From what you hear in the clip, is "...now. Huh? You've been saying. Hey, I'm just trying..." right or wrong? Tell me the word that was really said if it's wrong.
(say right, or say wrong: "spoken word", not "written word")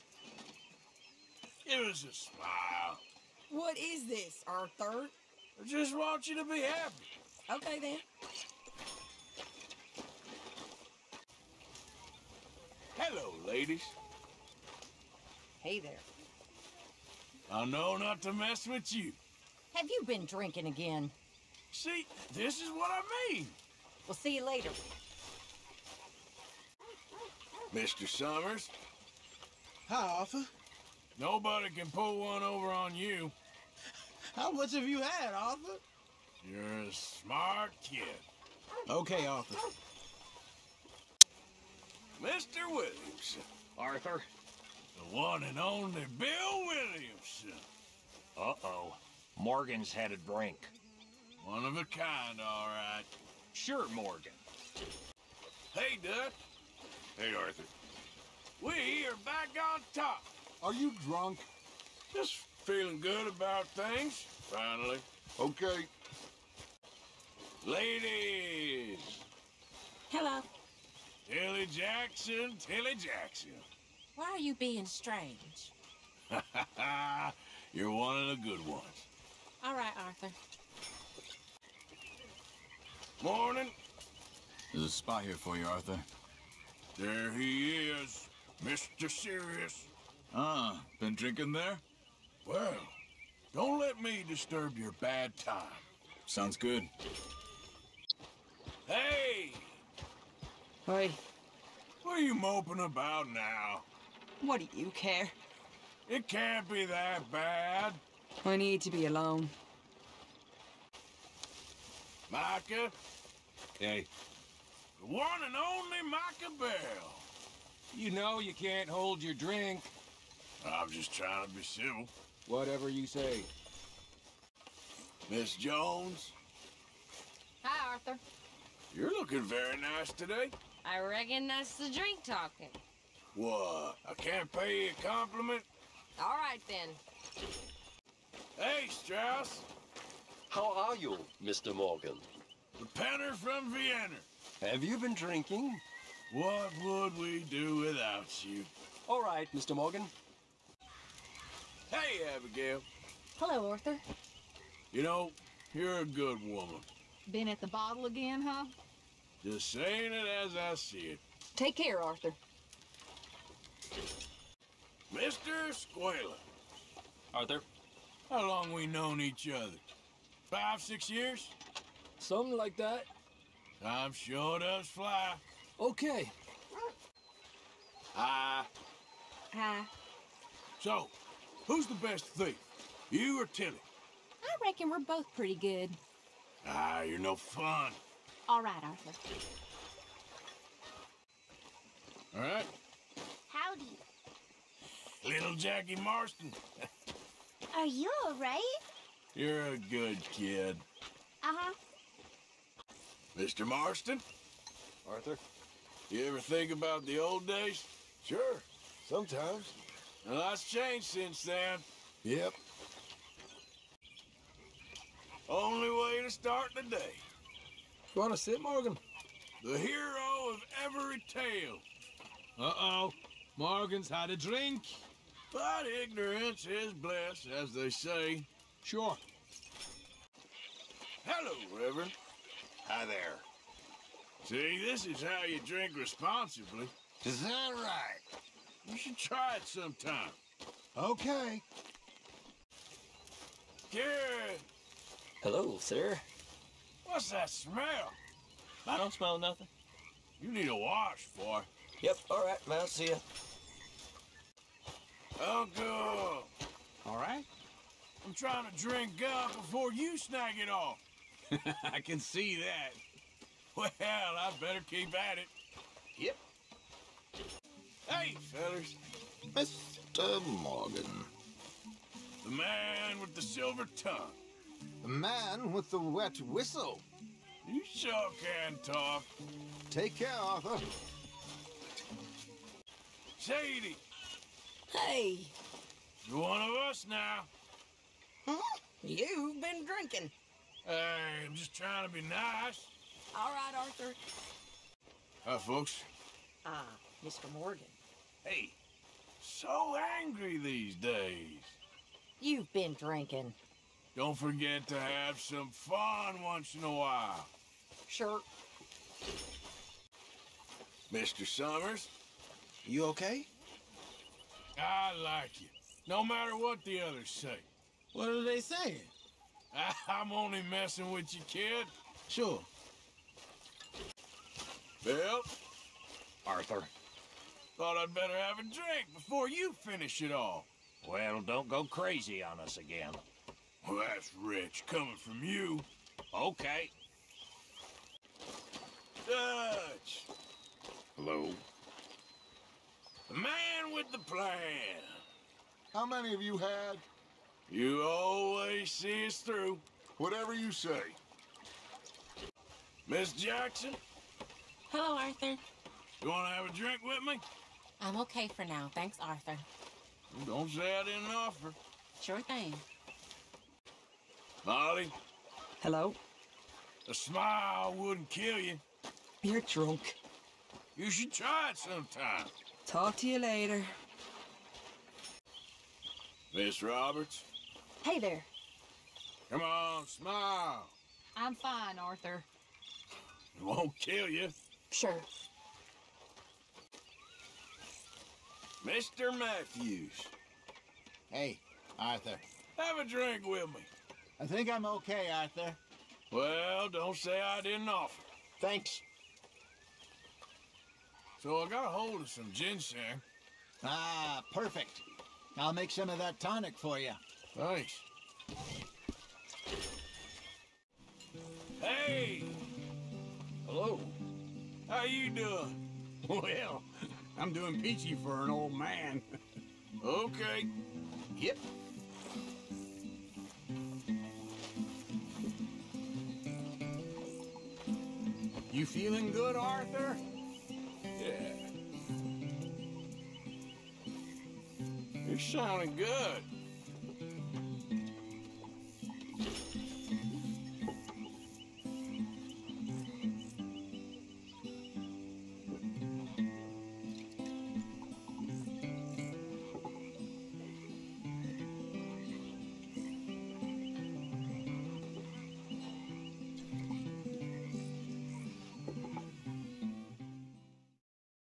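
wrong: "drinking", not "saying".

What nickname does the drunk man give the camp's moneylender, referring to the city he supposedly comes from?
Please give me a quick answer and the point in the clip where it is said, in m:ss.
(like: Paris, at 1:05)
The Penner from Vienna, at 2:22.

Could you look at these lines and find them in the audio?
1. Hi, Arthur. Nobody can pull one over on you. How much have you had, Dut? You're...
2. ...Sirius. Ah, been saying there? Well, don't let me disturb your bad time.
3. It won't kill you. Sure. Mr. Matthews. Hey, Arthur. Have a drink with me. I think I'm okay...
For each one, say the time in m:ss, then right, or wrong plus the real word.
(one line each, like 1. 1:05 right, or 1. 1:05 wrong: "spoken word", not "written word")
1. 0:29 wrong: "Arthur", not "Dut"
2. 1:29 wrong: "drinking", not "saying"
3. 6:23 right.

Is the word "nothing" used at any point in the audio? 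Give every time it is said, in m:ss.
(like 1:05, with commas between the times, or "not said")
4:09.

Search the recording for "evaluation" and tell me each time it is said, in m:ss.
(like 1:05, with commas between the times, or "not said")
not said.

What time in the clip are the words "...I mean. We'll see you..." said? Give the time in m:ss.
0:22.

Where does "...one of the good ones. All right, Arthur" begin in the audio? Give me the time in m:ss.
1:17.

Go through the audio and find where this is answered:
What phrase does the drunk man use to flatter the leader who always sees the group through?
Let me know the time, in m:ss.
5:43.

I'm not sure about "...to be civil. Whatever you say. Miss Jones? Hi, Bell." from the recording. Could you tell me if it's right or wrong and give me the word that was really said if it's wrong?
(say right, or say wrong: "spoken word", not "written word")
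wrong: "Arthur", not "Bell".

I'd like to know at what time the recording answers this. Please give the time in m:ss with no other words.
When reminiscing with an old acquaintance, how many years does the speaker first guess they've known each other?
2:50.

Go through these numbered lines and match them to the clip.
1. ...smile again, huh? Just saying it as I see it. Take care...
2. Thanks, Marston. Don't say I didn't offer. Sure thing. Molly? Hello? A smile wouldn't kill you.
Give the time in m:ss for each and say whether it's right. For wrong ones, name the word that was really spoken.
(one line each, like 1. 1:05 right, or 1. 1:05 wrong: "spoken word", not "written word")
1. 2:37 wrong: "bottle", not "smile"
2. 5:58 wrong: "Arthur", not "Marston".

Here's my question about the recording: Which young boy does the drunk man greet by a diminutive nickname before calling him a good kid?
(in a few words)
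Jackie Marston.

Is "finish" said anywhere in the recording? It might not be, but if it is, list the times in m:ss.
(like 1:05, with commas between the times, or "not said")
5:29.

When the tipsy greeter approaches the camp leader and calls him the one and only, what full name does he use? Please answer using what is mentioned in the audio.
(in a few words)
Bill Williamson.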